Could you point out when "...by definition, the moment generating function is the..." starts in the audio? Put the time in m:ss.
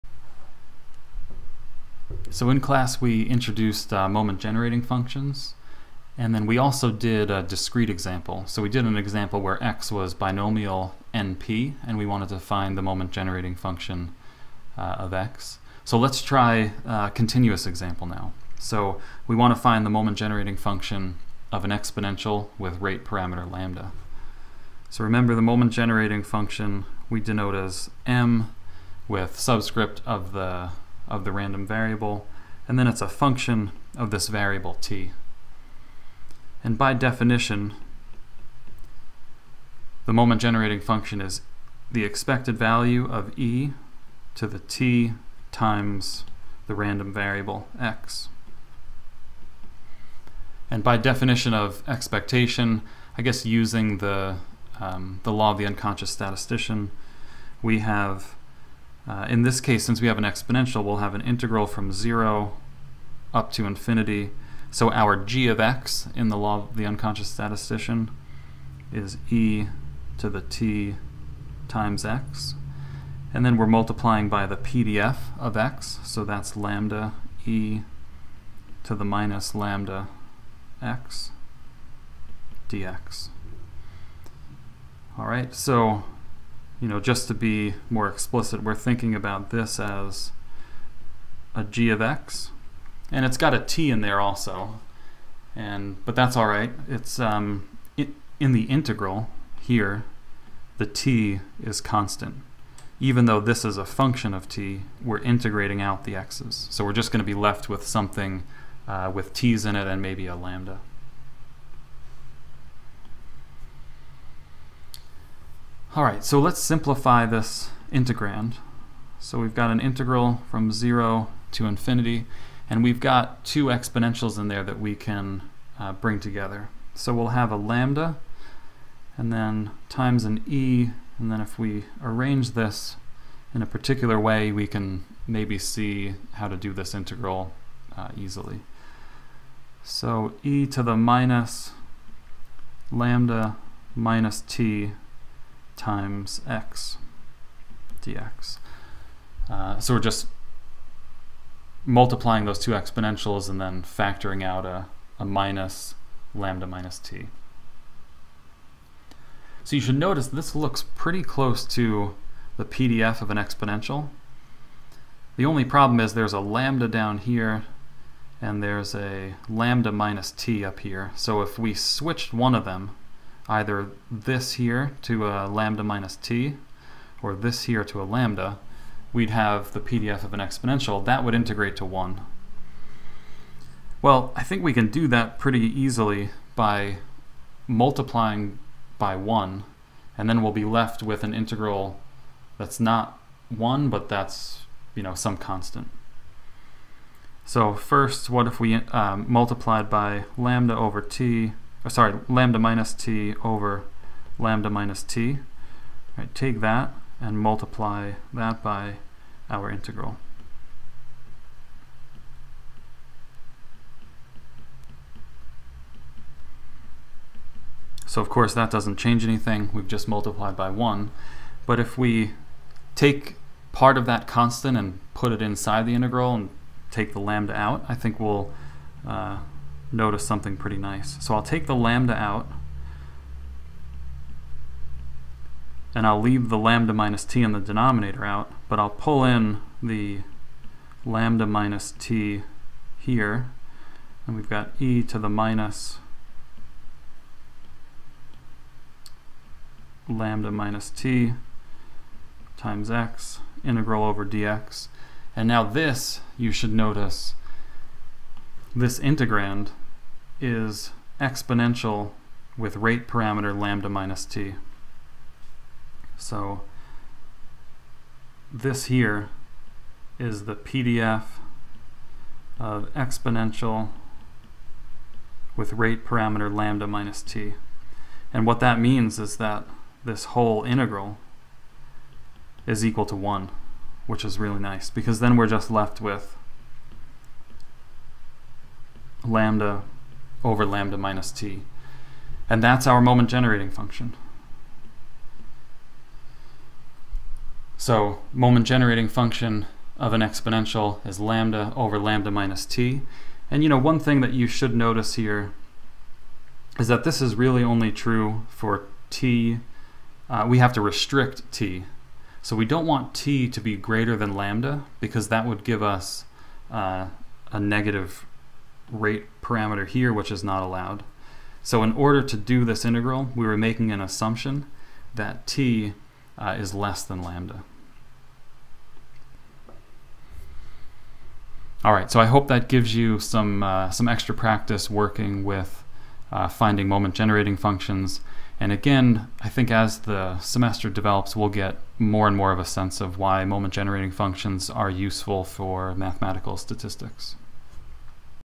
0:36.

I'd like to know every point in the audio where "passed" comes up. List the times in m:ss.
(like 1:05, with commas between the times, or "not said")
not said.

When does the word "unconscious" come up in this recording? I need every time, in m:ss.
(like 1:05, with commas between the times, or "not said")
0:55, 1:06.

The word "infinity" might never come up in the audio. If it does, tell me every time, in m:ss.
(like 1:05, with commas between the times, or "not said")
1:03, 2:01.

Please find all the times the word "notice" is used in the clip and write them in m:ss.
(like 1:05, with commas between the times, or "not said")
2:39, 3:49, 4:16, 5:04.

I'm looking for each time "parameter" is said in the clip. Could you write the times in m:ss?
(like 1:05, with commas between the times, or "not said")
0:23, 4:23, 4:36, 5:19.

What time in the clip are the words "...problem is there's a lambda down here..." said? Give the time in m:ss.
2:45.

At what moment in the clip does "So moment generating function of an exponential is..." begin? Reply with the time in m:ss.
4:57.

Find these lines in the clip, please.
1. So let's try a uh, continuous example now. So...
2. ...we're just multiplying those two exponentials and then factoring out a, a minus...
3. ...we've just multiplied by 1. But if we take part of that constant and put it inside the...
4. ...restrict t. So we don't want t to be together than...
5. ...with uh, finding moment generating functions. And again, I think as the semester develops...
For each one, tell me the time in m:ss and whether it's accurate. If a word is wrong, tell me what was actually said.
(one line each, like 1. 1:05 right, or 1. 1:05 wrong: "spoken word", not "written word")
1. 0:15 right
2. 2:29 right
3. 3:39 right
4. 5:10 wrong: "greater", not "together"
5. 5:35 right.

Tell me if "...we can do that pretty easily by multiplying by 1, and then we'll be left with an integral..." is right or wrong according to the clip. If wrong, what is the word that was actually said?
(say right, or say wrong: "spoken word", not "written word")
right.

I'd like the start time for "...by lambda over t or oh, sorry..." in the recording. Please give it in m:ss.
3:19.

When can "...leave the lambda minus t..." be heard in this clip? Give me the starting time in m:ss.
3:56.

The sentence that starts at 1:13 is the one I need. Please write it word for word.
And then we're multiplying by the PDF of x, so that's lambda e to the minus lambda x dx.